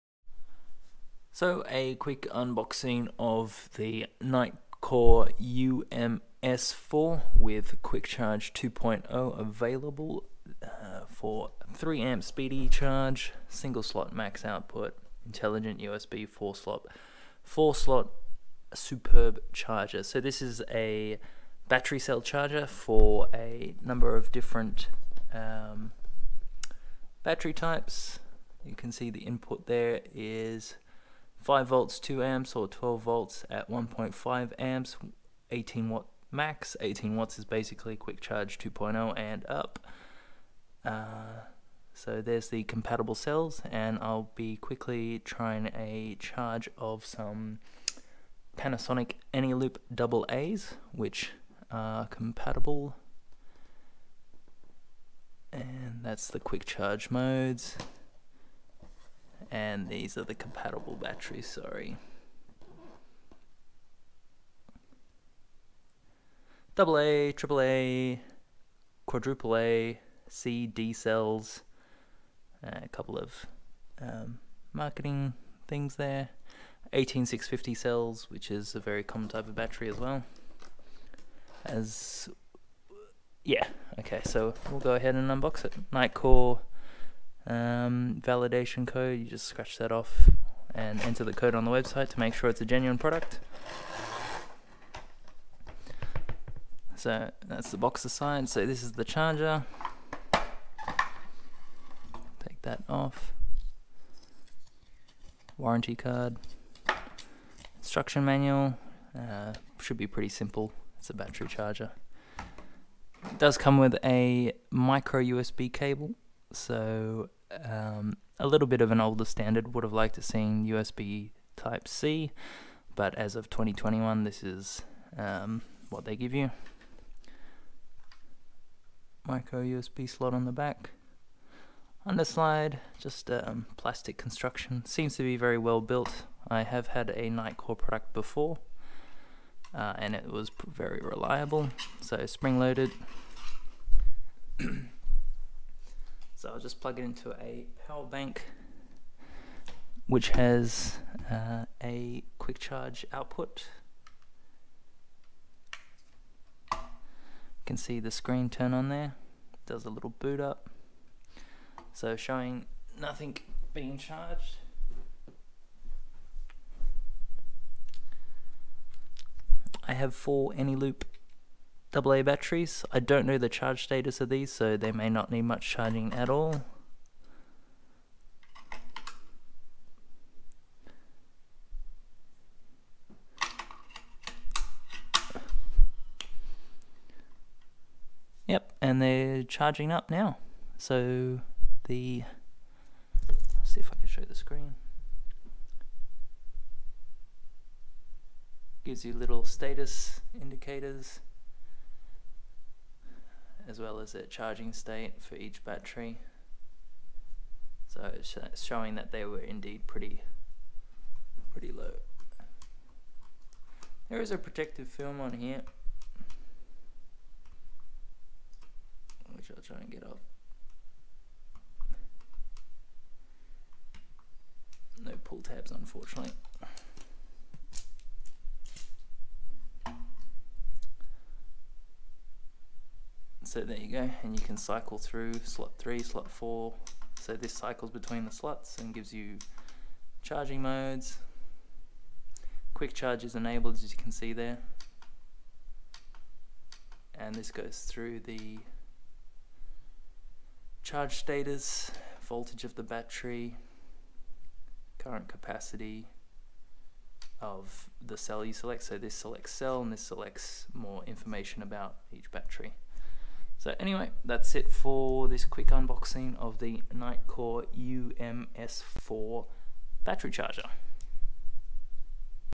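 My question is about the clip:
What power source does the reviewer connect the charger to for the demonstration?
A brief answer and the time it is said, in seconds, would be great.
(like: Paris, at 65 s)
power bank, at 147 s.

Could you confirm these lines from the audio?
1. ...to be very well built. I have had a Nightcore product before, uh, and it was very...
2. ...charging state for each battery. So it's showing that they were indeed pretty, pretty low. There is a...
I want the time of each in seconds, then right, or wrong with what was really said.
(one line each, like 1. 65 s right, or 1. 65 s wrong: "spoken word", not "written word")
1. 135 s right
2. 204 s right.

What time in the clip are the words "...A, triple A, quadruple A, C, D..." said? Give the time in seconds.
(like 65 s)
66 s.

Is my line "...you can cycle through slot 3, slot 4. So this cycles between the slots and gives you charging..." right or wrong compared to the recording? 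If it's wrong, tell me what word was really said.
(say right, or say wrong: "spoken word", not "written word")
right.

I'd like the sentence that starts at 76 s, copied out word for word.
18650 cells, which is a very common type of battery as well.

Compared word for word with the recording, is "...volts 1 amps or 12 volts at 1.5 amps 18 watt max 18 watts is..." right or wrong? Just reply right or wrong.
wrong.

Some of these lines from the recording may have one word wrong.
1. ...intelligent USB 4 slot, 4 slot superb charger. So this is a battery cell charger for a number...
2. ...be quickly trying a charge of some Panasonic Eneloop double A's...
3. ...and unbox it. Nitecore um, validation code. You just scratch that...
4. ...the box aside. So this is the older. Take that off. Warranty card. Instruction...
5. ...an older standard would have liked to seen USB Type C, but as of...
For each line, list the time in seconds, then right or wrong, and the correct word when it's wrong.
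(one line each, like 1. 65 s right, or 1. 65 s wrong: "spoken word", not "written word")
1. 15 s right
2. 44 s right
3. 85 s right
4. 97 s wrong: "charger", not "older"
5. 118 s right.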